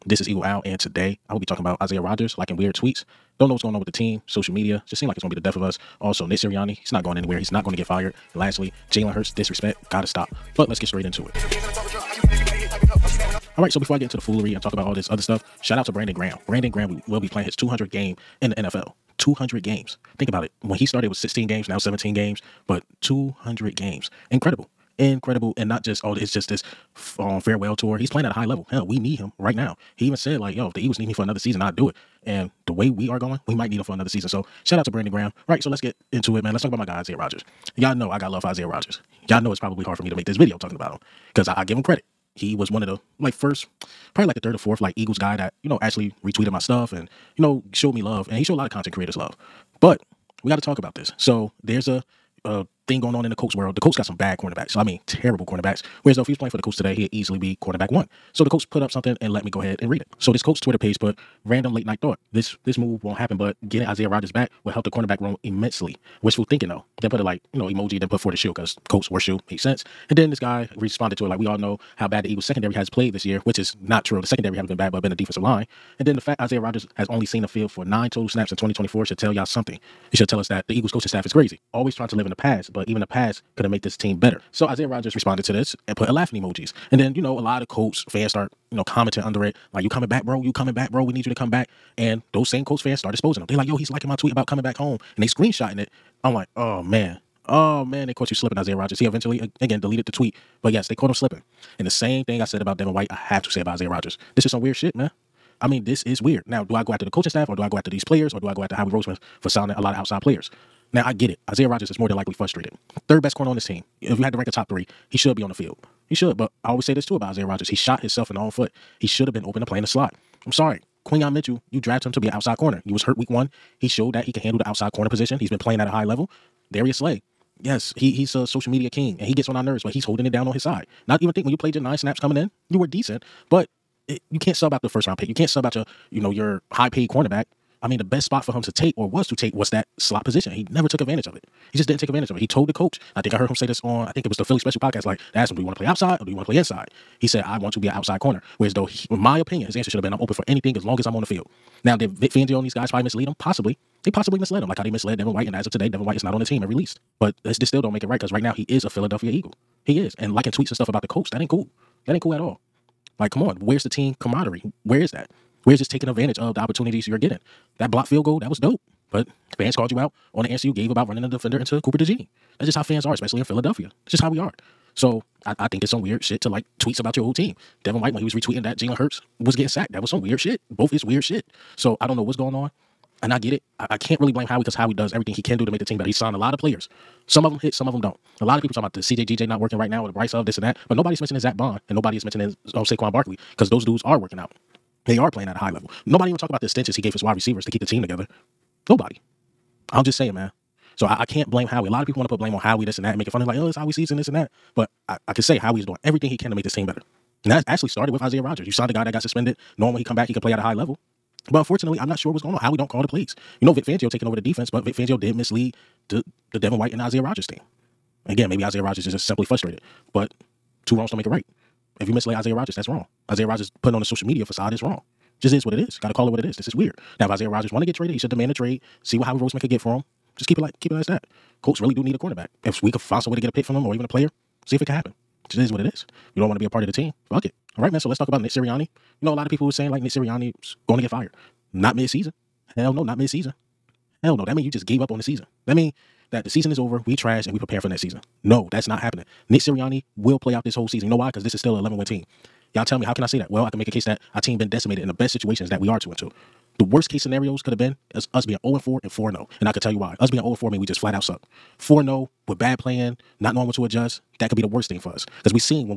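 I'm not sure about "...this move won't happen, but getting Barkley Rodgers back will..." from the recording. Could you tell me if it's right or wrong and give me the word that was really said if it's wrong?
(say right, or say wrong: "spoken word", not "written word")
wrong: "Isaiah", not "Barkley".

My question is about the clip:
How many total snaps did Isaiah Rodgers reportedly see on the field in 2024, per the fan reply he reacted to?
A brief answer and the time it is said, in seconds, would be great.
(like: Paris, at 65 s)
9, at 77 s.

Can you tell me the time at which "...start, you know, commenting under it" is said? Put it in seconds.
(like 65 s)
88 s.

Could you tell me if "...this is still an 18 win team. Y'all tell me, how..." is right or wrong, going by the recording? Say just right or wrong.
wrong.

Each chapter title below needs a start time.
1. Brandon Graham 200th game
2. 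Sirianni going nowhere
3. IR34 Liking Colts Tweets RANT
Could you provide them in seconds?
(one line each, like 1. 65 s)
1. 16 s
2. 238 s
3. 94 s.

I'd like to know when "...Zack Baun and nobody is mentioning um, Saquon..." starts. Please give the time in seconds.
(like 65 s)
191 s.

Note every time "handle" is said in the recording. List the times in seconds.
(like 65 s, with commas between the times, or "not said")
124 s.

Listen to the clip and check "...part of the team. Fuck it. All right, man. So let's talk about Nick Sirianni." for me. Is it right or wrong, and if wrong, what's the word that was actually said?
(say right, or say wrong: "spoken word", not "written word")
right.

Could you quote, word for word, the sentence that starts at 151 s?
Now, did Vic Fangio and these guys probably mislead him?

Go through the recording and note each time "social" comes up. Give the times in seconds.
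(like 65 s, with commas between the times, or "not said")
4 s, 128 s, 224 s.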